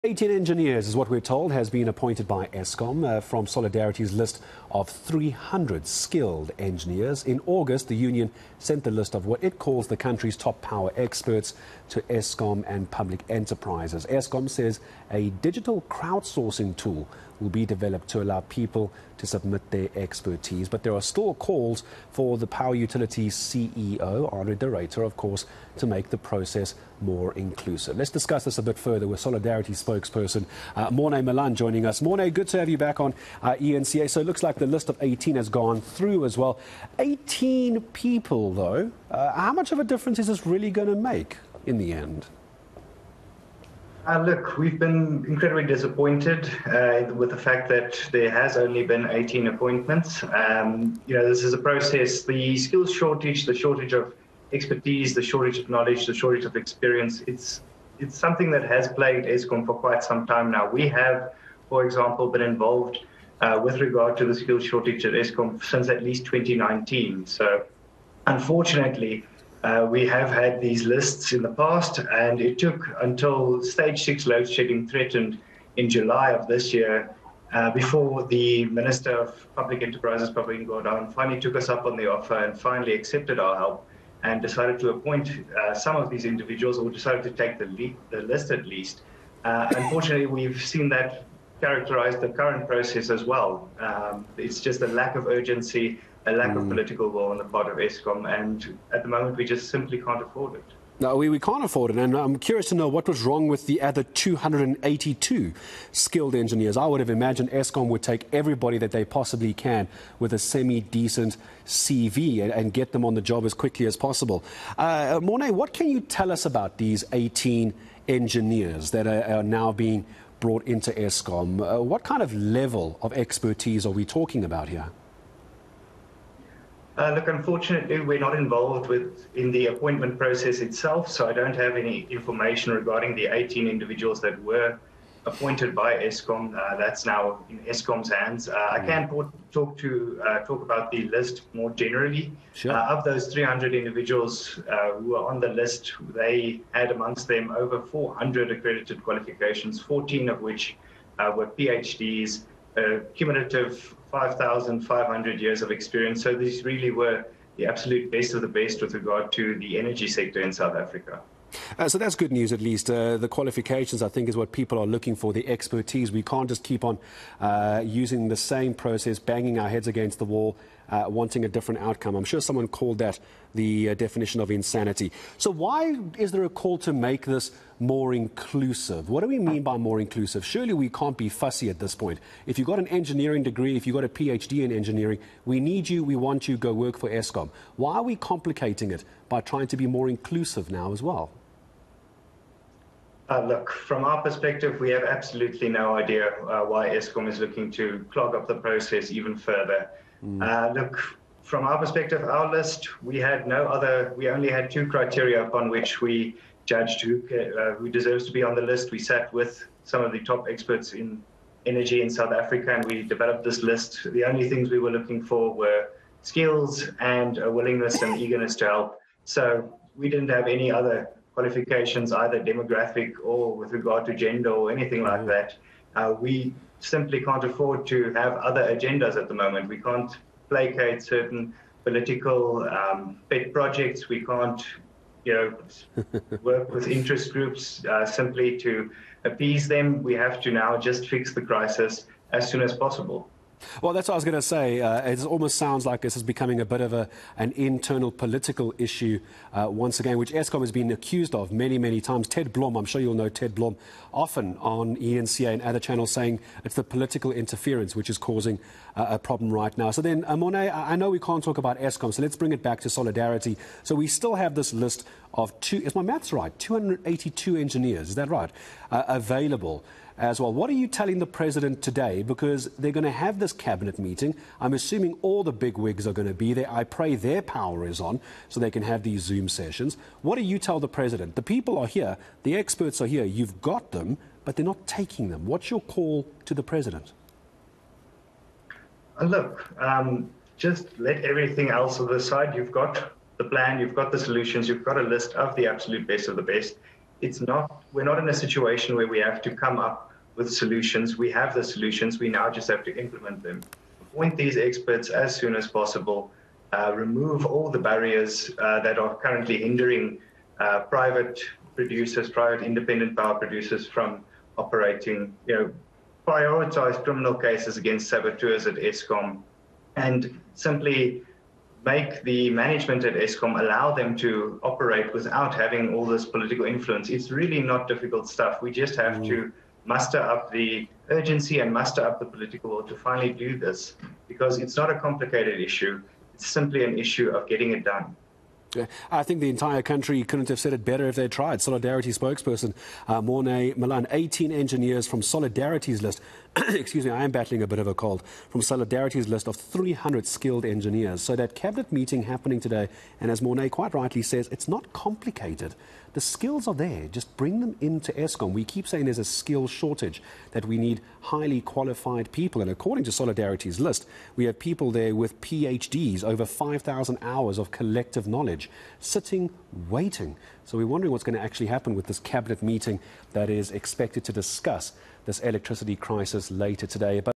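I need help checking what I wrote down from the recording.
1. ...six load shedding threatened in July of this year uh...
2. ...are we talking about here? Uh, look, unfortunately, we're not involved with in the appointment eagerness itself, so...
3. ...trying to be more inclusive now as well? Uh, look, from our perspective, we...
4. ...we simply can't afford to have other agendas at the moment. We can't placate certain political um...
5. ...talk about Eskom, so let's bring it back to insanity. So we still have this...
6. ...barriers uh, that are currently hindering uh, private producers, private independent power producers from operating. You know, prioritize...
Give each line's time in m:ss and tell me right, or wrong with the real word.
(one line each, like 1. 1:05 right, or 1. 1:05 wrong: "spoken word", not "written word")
1. 1:14 right
2. 2:03 wrong: "process", not "eagerness"
3. 3:09 right
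4. 3:46 right
5. 4:21 wrong: "solidarity", not "insanity"
6. 5:07 right.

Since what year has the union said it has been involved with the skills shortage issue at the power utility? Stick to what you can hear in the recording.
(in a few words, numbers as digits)
2019.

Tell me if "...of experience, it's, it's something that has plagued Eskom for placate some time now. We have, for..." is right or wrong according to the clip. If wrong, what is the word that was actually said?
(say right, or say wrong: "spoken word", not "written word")
wrong: "quite", not "placate".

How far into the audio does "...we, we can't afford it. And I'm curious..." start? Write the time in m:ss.
1:41.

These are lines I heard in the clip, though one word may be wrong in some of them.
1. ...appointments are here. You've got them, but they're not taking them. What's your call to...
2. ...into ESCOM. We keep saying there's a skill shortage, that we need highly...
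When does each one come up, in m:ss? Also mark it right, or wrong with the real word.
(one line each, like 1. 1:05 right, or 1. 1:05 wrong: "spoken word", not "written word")
1. 4:42 wrong: "experts", not "appointments"
2. 5:57 right.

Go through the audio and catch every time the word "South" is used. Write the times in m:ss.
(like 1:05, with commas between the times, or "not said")
2:40, 3:32.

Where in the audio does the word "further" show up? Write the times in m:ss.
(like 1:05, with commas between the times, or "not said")
0:28, 3:19.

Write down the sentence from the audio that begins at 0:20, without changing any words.
But there are still calls for the power utilities CEO, André de Ruyter, of course, to make the process more inclusive.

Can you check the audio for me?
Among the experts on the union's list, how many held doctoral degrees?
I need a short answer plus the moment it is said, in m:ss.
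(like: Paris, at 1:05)
14, at 2:29.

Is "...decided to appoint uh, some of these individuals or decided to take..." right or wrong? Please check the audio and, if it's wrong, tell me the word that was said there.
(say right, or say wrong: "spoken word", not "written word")
right.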